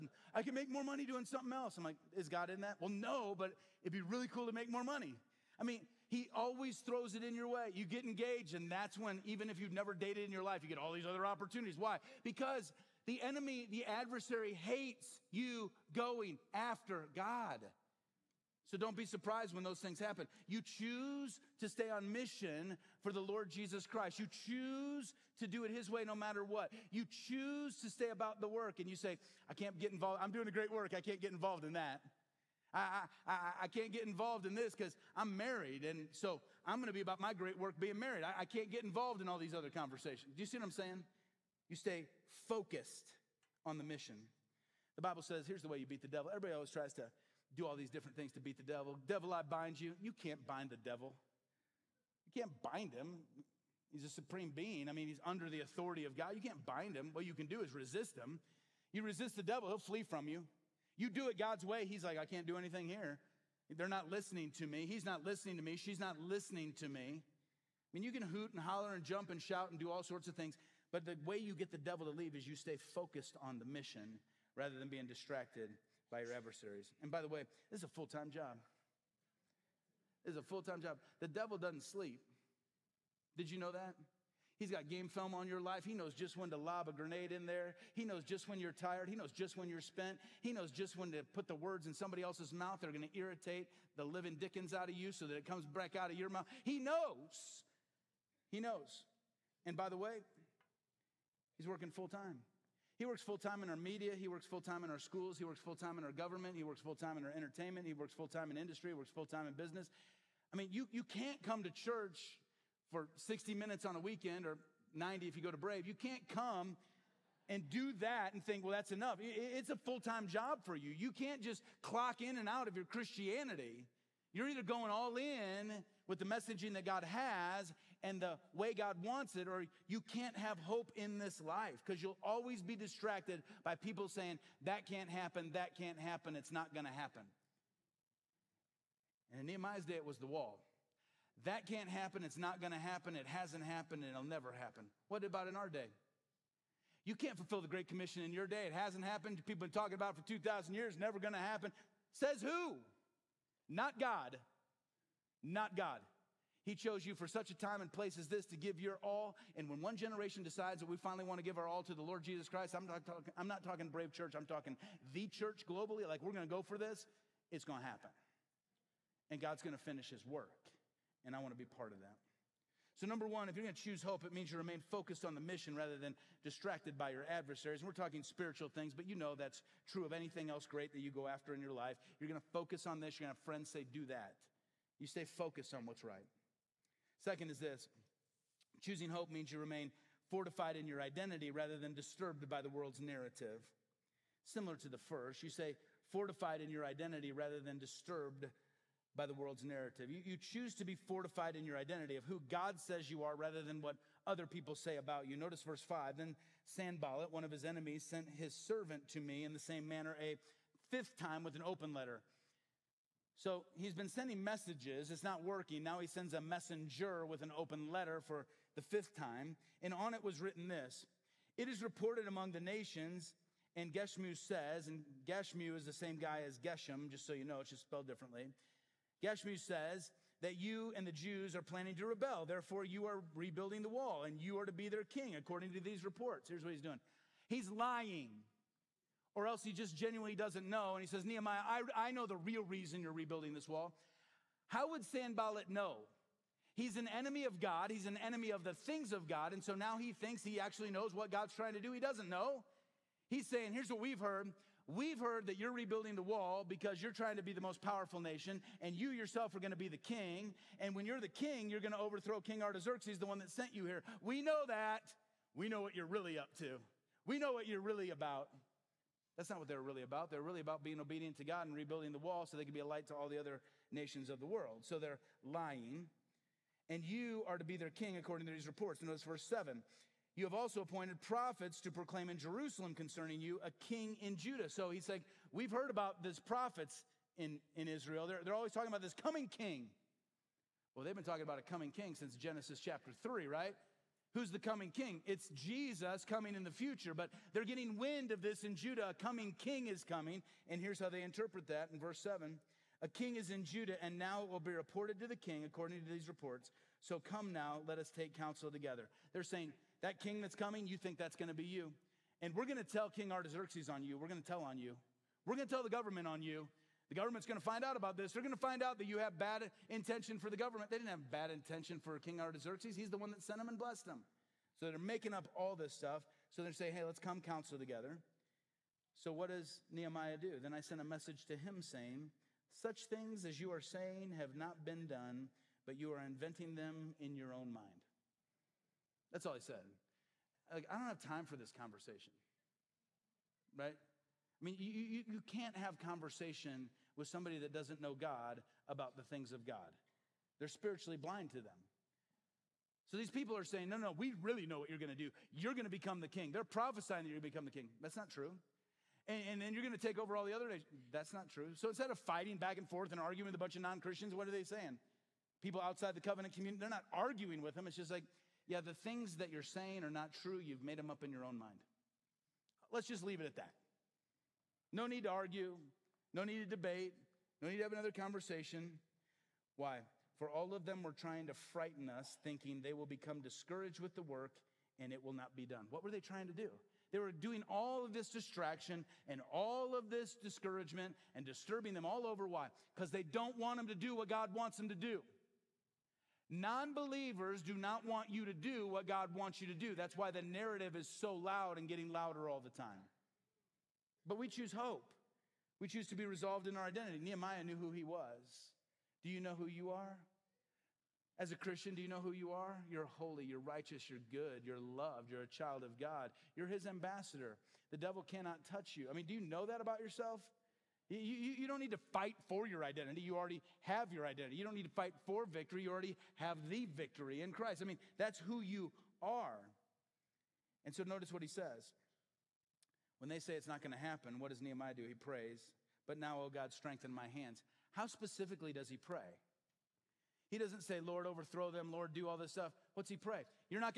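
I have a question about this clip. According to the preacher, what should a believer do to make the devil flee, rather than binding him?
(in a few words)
Resist him.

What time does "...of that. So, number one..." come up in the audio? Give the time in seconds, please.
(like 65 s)
171 s.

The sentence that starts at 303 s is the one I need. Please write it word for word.
A king is in Judah, and now it will be reported to the king according to these reports.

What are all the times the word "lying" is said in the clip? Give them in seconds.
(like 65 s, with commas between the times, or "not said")
237 s, 275 s.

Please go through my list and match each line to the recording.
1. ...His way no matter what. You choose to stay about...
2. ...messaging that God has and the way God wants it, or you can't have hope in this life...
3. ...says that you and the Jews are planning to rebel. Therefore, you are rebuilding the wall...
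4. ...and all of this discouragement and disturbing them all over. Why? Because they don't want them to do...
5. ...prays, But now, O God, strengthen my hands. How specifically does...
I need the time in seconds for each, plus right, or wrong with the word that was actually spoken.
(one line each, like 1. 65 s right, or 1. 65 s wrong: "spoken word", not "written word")
1. 25 s right
2. 126 s right
3. 229 s right
4. 389 s right
5. 435 s right.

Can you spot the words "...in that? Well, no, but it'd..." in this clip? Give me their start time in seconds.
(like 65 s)
2 s.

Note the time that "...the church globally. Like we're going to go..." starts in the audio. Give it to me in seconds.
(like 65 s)
165 s.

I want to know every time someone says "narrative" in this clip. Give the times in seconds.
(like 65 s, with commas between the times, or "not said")
192 s, 199 s, 400 s.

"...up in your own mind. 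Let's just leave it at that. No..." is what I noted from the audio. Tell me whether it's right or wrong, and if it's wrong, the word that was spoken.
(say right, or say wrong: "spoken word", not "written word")
right.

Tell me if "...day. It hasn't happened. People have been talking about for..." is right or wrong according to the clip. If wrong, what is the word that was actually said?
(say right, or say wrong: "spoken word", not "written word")
right.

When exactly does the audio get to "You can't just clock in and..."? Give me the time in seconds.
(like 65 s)
120 s.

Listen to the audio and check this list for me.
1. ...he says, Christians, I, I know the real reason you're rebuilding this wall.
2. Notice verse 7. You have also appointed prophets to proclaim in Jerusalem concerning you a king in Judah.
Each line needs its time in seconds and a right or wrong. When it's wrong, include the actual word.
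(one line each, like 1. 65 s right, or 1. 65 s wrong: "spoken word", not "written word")
1. 241 s wrong: "Nehemiah", not "Christians"
2. 279 s right.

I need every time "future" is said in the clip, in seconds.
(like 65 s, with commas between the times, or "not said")
296 s.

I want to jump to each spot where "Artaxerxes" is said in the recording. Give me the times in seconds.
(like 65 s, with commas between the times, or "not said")
262 s, 313 s, 322 s.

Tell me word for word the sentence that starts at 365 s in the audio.
People outside the covenant community, they're not arguing with them.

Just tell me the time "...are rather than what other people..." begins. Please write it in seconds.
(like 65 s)
203 s.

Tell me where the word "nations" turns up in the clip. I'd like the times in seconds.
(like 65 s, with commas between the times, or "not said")
222 s, 258 s, 273 s, 360 s.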